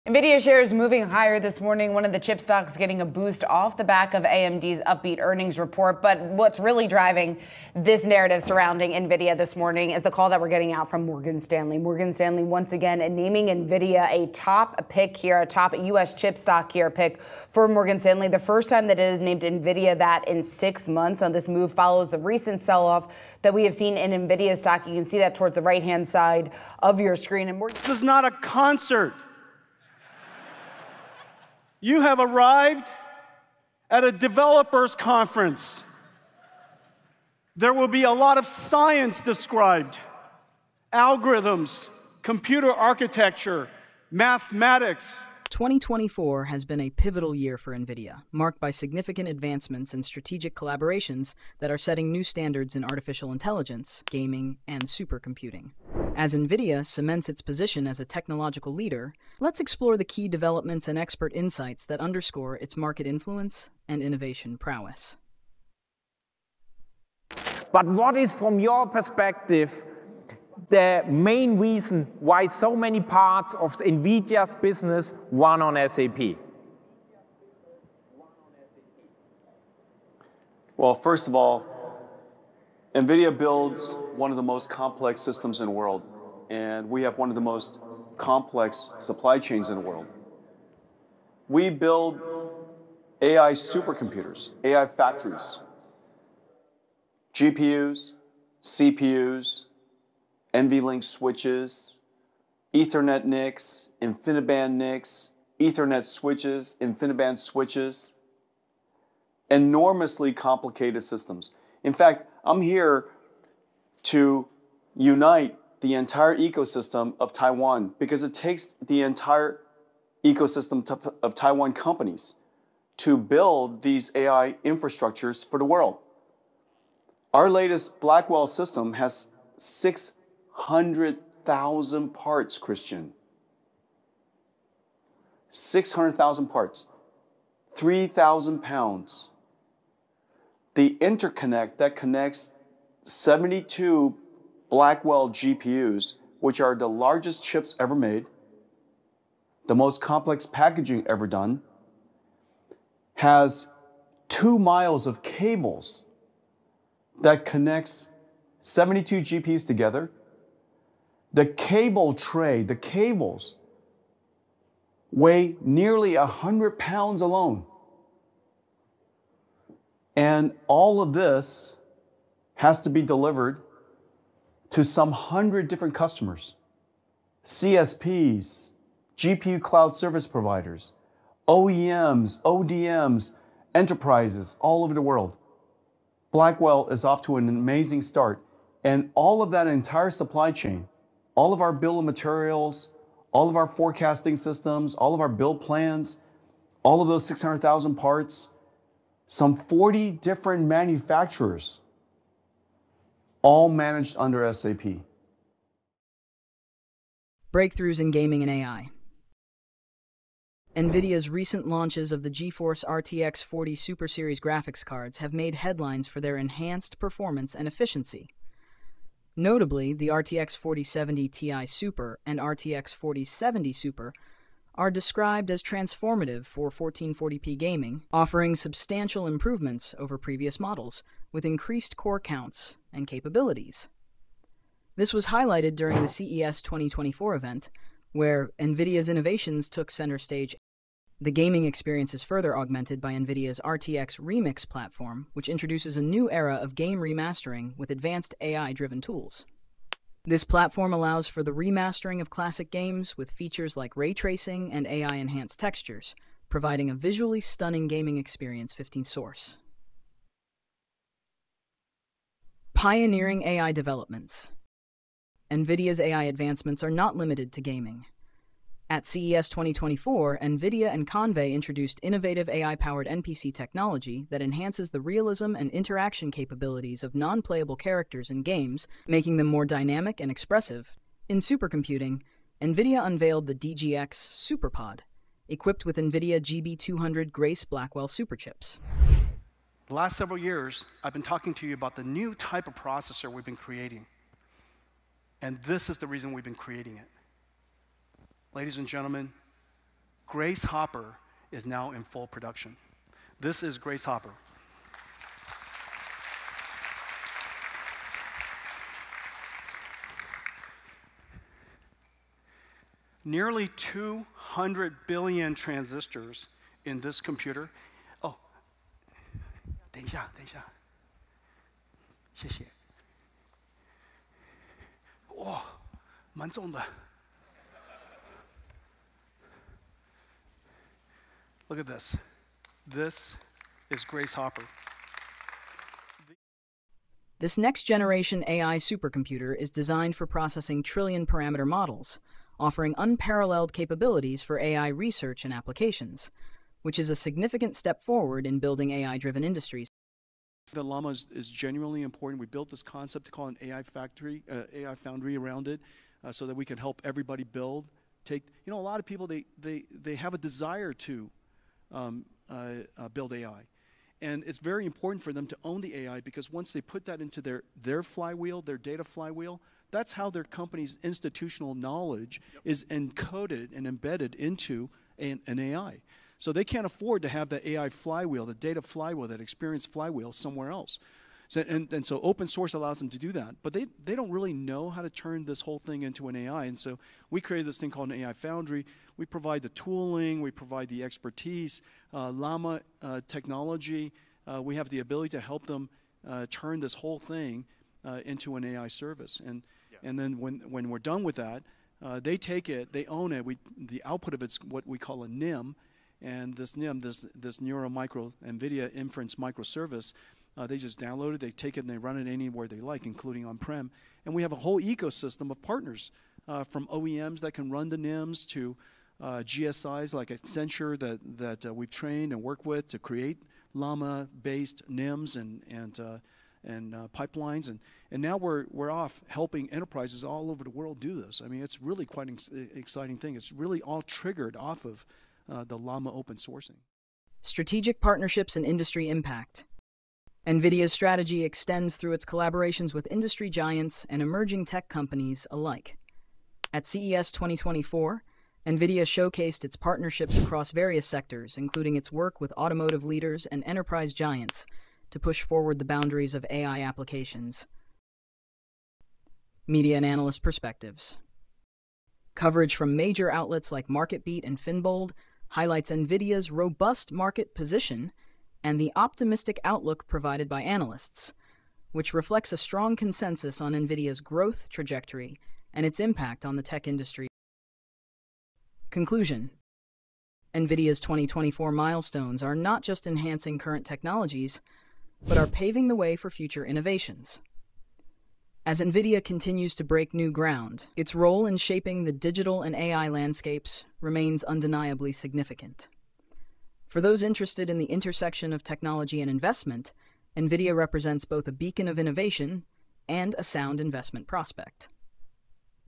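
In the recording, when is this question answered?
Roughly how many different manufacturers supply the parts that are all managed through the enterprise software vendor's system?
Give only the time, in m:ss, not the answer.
3:19.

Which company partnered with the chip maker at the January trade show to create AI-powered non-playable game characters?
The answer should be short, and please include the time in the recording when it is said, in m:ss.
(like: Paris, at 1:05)
Convai, at 4:31.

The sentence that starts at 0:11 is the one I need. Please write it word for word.
Morgan Stanley, once again, naming Nvidia a top pick here, a top U.S.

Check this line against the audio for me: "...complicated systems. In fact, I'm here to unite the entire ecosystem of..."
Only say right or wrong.
right.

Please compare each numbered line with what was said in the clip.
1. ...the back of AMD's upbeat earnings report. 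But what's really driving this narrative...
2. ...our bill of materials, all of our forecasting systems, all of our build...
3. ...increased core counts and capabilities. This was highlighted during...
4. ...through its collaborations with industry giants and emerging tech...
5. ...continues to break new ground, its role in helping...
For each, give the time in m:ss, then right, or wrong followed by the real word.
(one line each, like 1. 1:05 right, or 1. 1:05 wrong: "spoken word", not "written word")
1. 0:03 right
2. 3:11 right
3. 3:51 right
4. 7:21 right
5. 8:09 wrong: "shaping", not "helping".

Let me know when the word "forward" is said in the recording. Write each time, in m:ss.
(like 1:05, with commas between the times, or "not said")
5:48, 7:35.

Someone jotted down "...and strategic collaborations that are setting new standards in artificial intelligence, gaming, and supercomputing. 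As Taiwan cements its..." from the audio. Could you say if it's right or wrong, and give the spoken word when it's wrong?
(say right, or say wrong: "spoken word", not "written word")
wrong: "NVIDIA", not "Taiwan".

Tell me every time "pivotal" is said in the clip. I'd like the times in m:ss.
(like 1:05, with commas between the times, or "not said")
0:46.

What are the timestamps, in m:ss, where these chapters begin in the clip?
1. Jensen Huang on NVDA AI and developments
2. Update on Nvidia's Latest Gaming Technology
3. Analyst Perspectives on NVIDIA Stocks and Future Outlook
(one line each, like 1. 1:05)
1. 1:30
2. 3:30
3. 7:30.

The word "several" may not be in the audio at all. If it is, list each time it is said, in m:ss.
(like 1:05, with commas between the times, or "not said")
4:50.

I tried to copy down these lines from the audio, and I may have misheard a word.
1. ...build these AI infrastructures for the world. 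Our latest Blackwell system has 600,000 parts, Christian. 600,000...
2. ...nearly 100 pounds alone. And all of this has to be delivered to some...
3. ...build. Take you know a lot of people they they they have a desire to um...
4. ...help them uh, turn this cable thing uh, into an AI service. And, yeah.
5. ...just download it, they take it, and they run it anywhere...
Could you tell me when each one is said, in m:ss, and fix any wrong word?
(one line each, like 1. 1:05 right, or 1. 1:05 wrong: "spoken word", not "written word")
1. 2:03 right
2. 2:45 right
3. 5:57 right
4. 6:35 wrong: "whole", not "cable"
5. 6:50 right.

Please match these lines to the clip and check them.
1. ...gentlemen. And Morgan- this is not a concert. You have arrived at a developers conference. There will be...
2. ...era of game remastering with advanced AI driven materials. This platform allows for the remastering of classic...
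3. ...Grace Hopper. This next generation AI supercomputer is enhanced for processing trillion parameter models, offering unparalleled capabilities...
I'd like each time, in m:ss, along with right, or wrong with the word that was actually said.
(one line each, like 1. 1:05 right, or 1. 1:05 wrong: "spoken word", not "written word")
1. 0:27 wrong: "screen", not "gentlemen"
2. 4:06 wrong: "tools", not "materials"
3. 5:34 wrong: "designed", not "enhanced".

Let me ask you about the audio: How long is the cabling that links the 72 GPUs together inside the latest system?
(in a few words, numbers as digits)
two miles.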